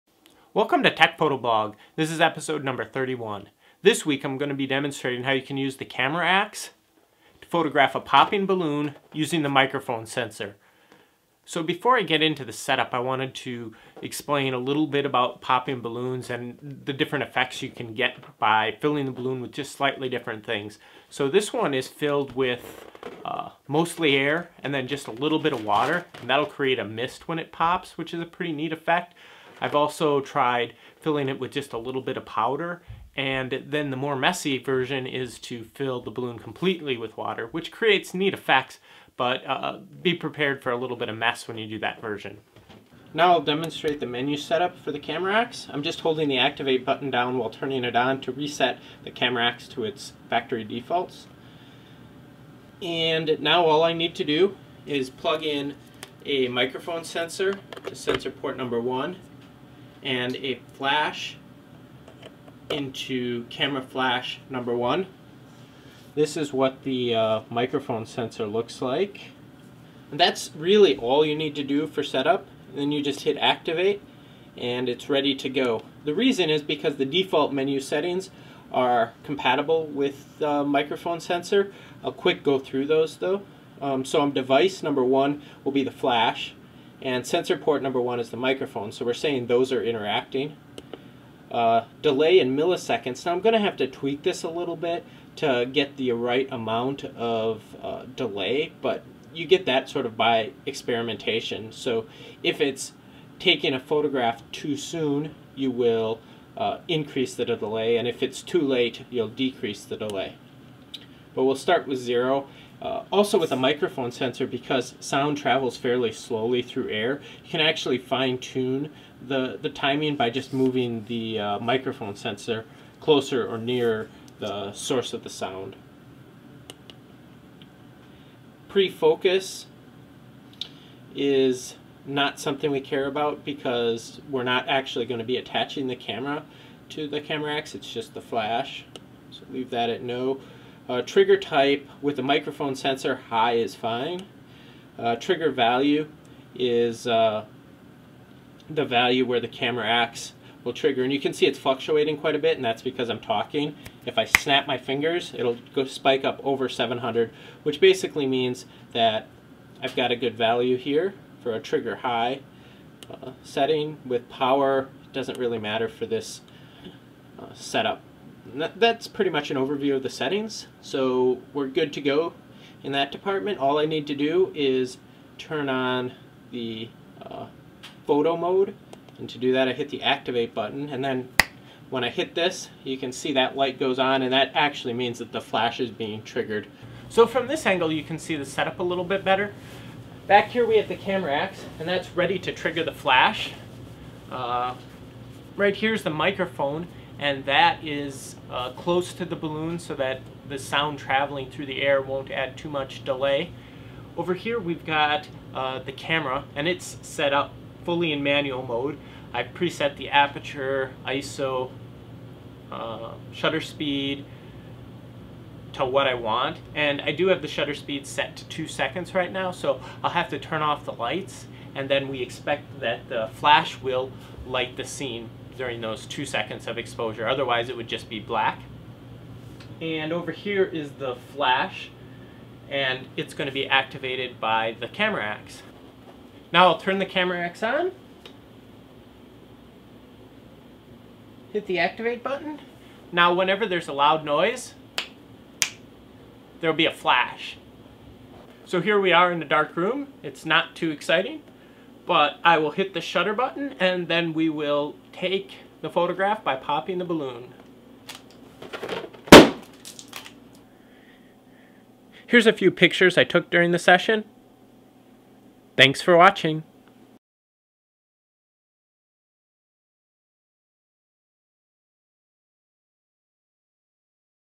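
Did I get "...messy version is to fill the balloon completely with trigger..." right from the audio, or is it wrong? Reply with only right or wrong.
wrong.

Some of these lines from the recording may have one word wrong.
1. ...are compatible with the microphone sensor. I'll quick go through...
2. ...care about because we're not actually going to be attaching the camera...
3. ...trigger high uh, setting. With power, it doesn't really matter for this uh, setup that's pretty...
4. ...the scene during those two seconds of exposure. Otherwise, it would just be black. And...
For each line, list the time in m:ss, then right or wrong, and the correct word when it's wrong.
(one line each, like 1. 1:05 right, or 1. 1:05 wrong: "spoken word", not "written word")
1. 1:18 right
2. 2:12 right
3. 2:41 right
4. 3:44 right.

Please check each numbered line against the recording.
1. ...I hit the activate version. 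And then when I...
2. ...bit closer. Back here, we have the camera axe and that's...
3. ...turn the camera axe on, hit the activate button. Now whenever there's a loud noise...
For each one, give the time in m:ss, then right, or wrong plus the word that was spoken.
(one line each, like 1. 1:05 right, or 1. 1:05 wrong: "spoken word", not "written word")
1. 2:59 wrong: "button", not "version"
2. 3:09 wrong: "better", not "closer"
3. 3:56 right.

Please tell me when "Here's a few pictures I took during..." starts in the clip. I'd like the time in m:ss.
4:22.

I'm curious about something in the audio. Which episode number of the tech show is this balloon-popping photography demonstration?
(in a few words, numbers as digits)
31.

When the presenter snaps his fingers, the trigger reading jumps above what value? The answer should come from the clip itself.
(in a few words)
700.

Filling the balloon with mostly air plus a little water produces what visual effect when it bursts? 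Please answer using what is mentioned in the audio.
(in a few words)
a mist.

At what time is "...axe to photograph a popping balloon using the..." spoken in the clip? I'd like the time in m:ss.
0:06.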